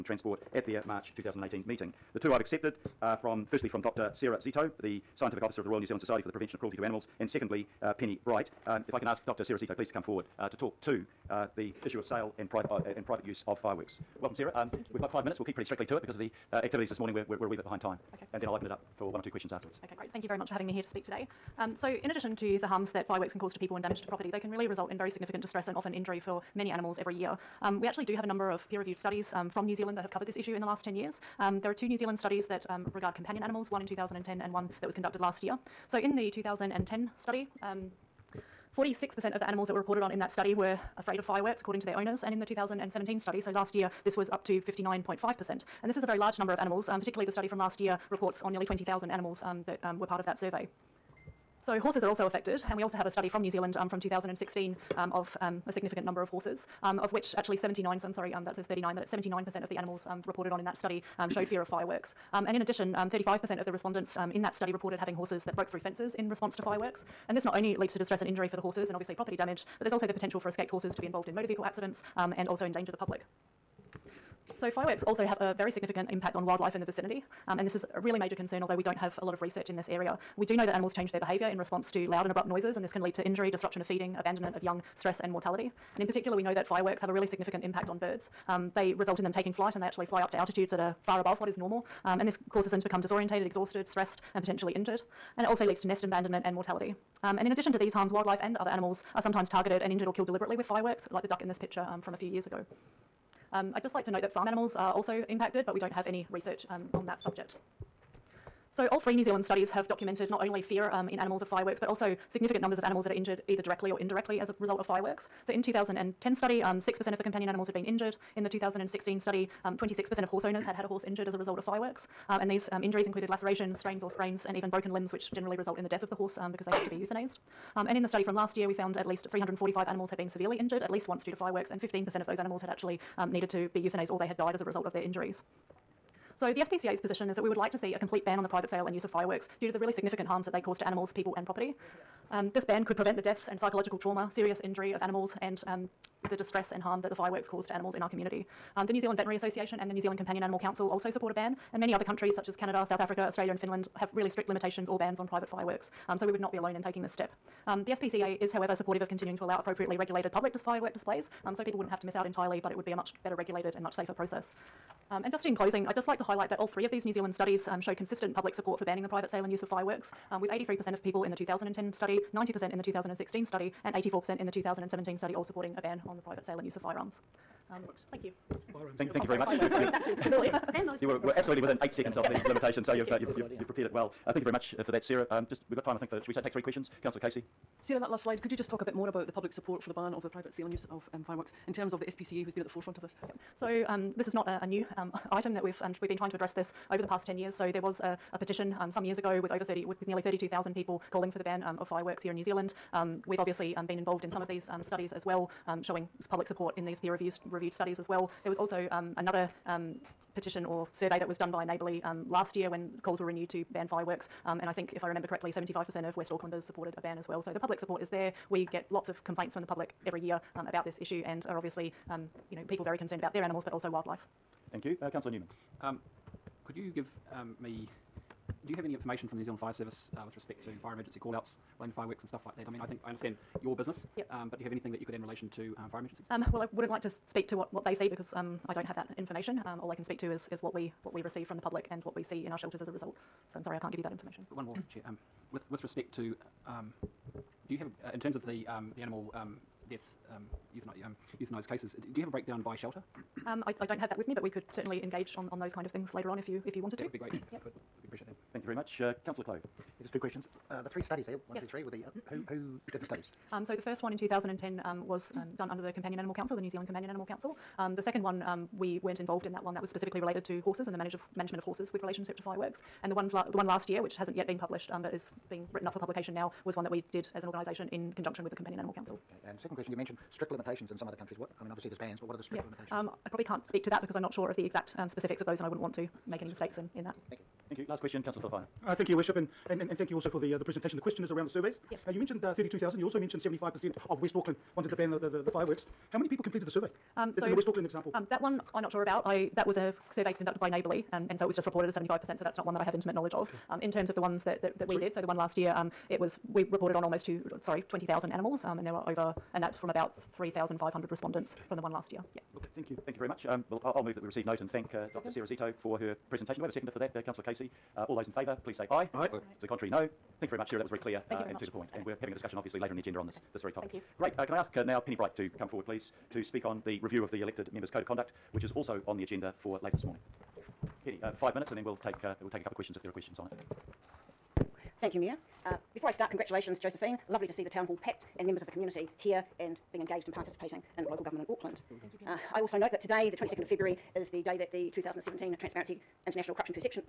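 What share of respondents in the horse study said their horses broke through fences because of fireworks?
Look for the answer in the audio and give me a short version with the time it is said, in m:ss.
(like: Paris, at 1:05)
35%, at 1:02.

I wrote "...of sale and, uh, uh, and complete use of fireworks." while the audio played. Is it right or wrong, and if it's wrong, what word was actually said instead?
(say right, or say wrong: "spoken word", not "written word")
wrong: "private", not "complete".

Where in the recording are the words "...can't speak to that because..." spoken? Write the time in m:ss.
4:43.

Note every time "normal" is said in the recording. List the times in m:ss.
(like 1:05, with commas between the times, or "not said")
1:31.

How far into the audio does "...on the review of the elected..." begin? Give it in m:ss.
5:26.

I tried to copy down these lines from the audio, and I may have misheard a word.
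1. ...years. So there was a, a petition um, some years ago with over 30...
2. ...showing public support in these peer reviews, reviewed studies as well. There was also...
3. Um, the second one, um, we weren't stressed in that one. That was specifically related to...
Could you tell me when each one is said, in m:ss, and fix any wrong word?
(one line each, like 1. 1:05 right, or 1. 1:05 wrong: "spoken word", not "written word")
1. 3:17 right
2. 3:25 right
3. 4:27 wrong: "involved", not "stressed".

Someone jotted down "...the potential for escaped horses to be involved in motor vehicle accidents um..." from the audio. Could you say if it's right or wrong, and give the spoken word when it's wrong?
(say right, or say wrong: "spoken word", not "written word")
right.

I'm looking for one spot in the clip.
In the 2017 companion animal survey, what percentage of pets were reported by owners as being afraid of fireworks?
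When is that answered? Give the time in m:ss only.
0:44.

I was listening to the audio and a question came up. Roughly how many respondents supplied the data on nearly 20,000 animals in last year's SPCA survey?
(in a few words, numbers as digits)
3,500.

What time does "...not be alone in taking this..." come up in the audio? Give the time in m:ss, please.
2:36.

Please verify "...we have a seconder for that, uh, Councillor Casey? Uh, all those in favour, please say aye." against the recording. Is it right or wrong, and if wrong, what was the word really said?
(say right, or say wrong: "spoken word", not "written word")
right.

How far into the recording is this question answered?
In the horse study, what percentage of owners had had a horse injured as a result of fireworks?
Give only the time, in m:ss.
1:59.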